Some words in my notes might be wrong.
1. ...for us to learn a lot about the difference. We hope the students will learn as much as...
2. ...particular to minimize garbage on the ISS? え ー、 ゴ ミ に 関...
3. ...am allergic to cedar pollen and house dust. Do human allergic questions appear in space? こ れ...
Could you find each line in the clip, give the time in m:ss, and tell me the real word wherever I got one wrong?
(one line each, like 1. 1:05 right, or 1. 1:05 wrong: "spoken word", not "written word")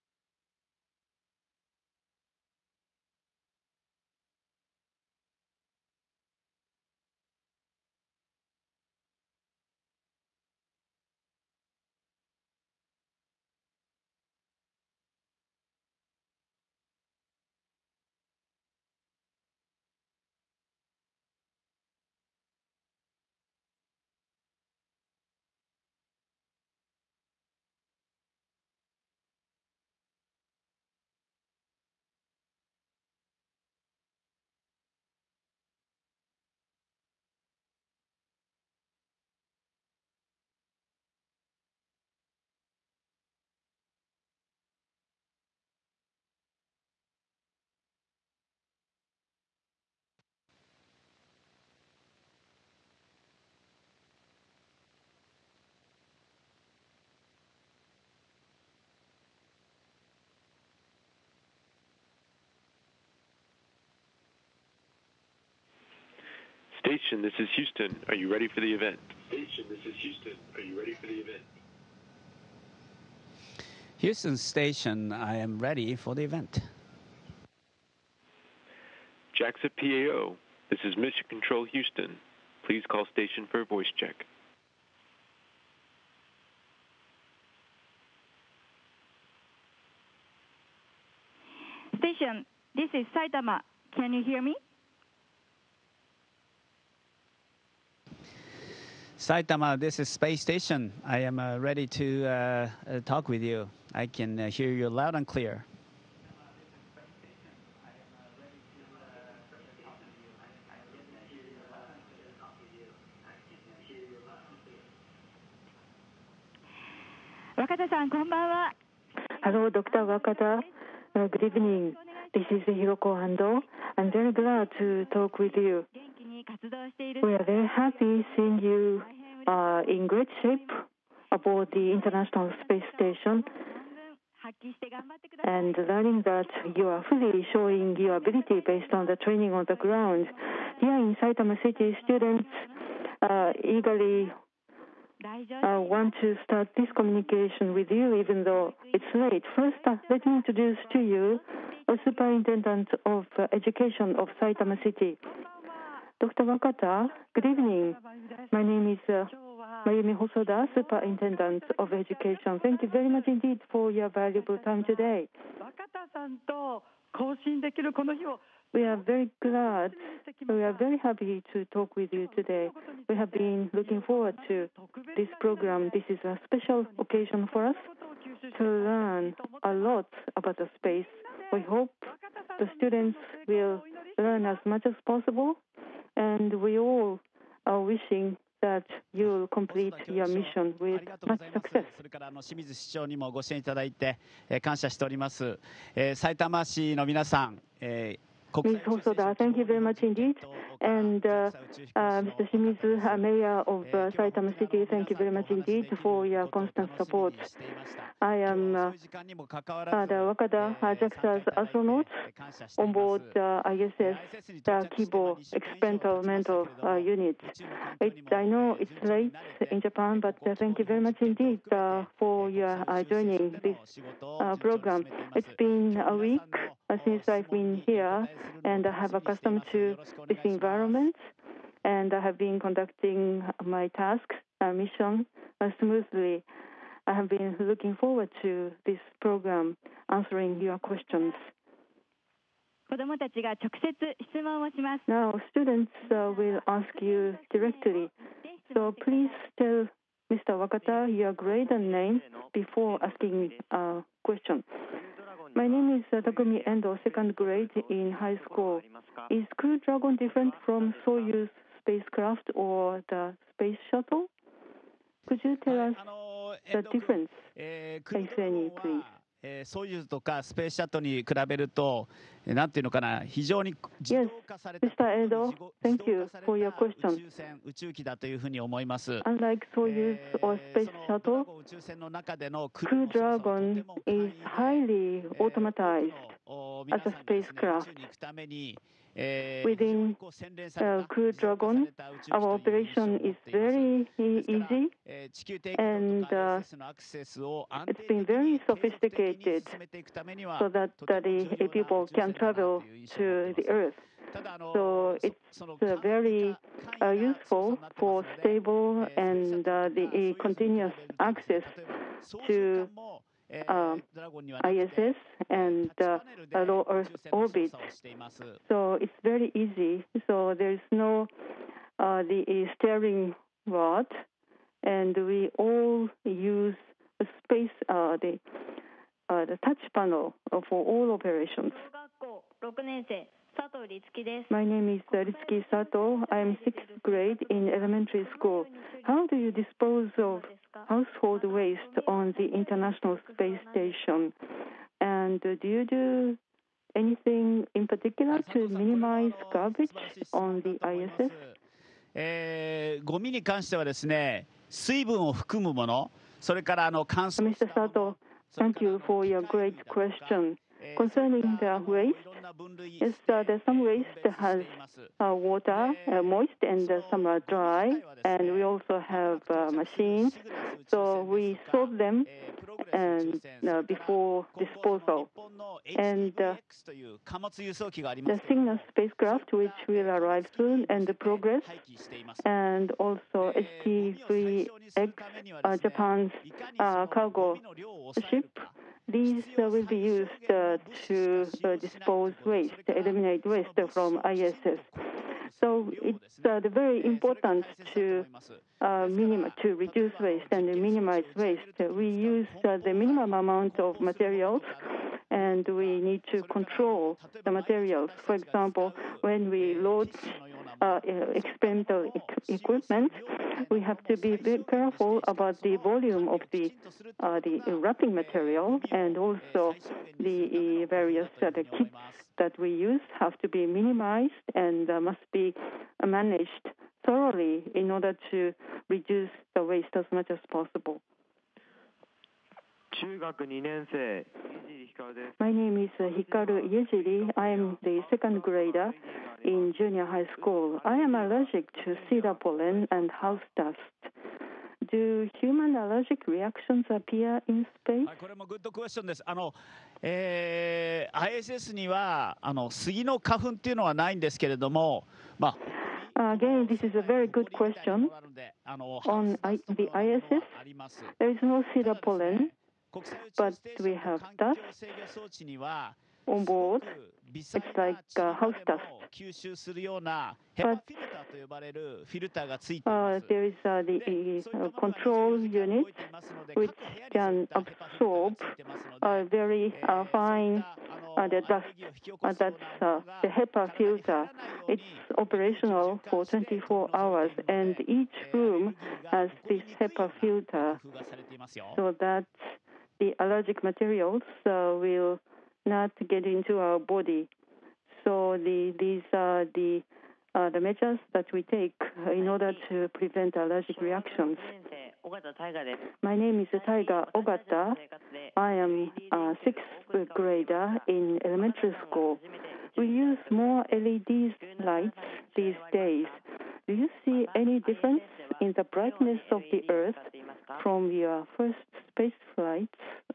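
1. 2:57 wrong: "space", not "difference"
2. 5:47 right
3. 7:20 wrong: "reactions", not "questions".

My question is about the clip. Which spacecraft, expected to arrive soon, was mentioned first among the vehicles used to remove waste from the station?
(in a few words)
Cygnus.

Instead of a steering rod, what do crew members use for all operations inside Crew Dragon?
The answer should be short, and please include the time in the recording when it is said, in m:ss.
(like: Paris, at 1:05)
touch panel, at 5:29.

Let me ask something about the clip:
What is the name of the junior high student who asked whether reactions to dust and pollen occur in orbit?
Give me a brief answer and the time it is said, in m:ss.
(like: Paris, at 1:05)
Hikaru Yujiri, at 7:15.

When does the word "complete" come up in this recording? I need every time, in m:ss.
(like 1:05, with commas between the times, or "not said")
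3:09.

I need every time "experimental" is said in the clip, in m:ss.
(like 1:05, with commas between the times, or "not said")
3:35, 6:51.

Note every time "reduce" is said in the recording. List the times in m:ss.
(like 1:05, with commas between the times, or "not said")
6:39, 7:08.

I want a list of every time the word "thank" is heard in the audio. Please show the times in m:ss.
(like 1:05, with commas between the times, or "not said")
2:42, 3:19, 3:24, 3:40, 5:58.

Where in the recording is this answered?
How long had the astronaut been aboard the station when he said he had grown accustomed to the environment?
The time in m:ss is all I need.
3:45.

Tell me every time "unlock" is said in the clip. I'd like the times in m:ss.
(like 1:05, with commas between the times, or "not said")
not said.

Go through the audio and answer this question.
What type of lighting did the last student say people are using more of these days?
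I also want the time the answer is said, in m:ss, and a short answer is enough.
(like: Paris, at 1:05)
LED lights, at 8:33.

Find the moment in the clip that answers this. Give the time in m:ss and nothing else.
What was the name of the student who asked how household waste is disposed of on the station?
5:35.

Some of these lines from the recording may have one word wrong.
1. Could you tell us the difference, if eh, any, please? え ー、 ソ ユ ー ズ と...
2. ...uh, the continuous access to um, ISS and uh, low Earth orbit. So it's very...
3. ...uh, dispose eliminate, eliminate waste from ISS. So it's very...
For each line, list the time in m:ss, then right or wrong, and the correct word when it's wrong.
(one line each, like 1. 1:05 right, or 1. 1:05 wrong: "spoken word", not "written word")
1. 4:25 right
2. 5:09 right
3. 6:31 wrong: "waste", not "eliminate".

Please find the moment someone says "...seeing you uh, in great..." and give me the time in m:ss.
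2:08.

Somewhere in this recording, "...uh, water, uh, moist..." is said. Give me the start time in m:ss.
6:05.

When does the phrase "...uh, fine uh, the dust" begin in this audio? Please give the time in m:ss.
7:59.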